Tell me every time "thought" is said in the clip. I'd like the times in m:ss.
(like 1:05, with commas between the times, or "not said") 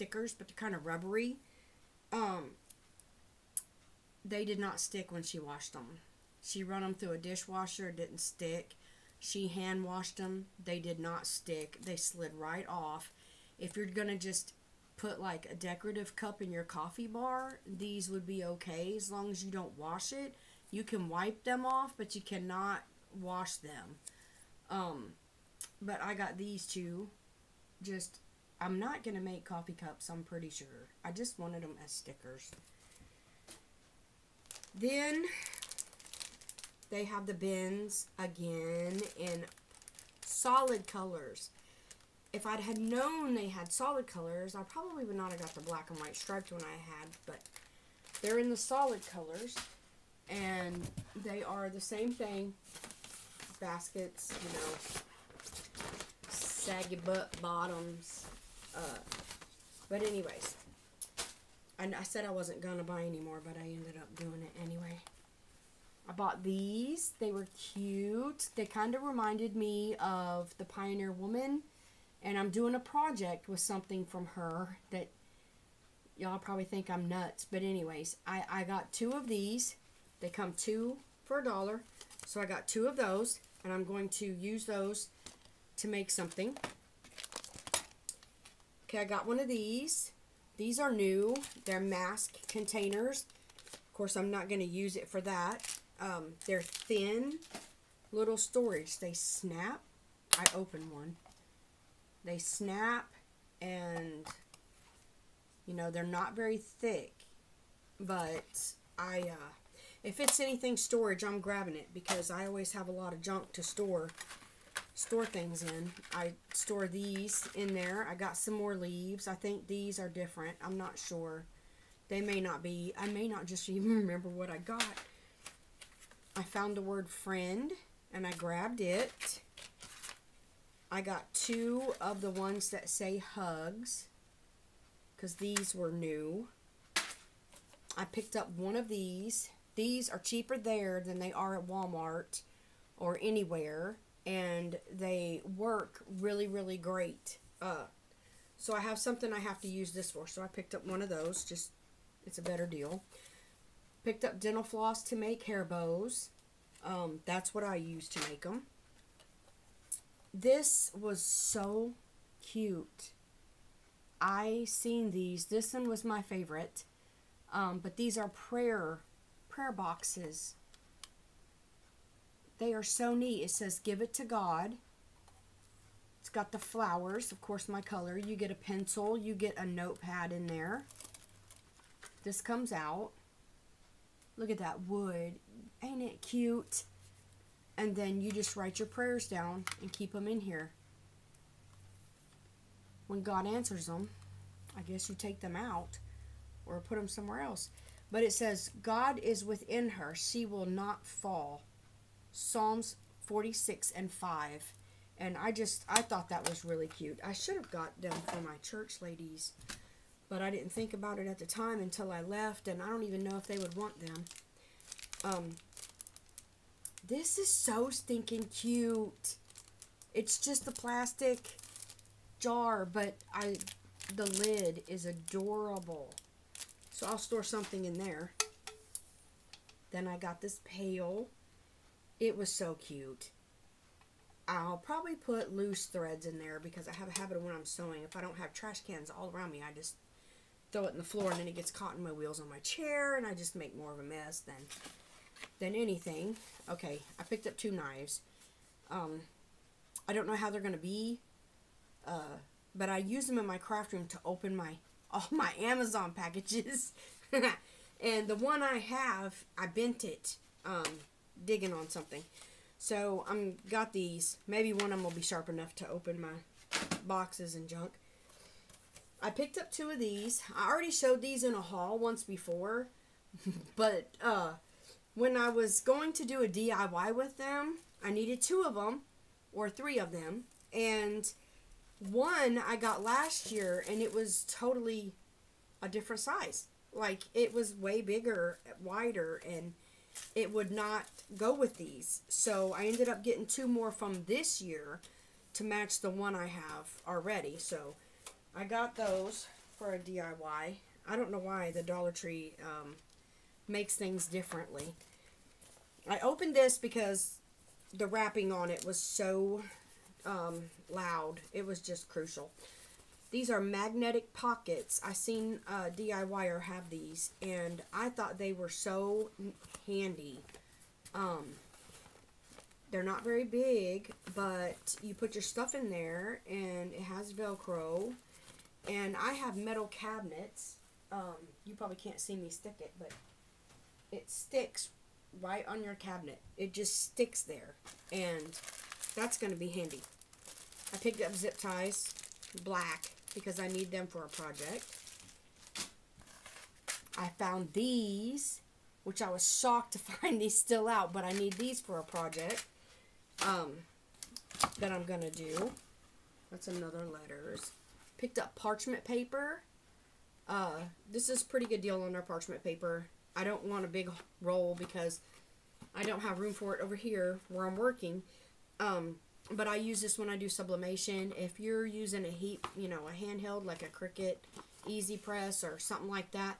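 3:26, 5:18.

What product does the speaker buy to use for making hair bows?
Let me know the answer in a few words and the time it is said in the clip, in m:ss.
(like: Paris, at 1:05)
dental floss, at 2:34.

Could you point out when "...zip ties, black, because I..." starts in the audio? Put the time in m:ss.
5:41.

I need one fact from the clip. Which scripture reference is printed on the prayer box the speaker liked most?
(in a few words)
Psalms 46:5.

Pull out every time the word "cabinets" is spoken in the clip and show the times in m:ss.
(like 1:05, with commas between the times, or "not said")
5:29, 5:35.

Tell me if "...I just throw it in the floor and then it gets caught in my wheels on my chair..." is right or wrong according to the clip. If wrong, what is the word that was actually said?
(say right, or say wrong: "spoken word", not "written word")
right.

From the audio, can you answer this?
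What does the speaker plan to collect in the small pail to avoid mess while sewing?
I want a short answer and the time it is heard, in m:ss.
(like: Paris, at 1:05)
loose threads, at 3:55.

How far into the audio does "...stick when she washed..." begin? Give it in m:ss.
0:04.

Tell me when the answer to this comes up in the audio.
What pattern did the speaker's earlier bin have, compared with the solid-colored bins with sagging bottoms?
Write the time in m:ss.
0:45.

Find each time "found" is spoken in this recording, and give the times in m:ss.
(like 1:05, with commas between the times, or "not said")
2:06, 5:47.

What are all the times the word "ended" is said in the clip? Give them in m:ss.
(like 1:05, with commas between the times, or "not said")
1:03, 4:52.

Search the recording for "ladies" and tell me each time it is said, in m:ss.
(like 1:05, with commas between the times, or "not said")
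3:29.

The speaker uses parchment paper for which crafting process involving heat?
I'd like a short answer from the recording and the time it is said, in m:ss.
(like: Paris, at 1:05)
sublimation, at 6:10.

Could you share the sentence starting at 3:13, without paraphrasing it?
When God answers them, I guess you take them out or put them somewhere else.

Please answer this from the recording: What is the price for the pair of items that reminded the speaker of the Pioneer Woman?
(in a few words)
two for a dollar.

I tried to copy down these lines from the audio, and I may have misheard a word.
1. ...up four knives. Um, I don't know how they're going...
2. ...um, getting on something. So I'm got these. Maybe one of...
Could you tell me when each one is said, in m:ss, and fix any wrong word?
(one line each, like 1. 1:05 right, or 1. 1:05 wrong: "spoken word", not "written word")
1. 4:07 wrong: "two", not "four"
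2. 4:20 wrong: "digging", not "getting".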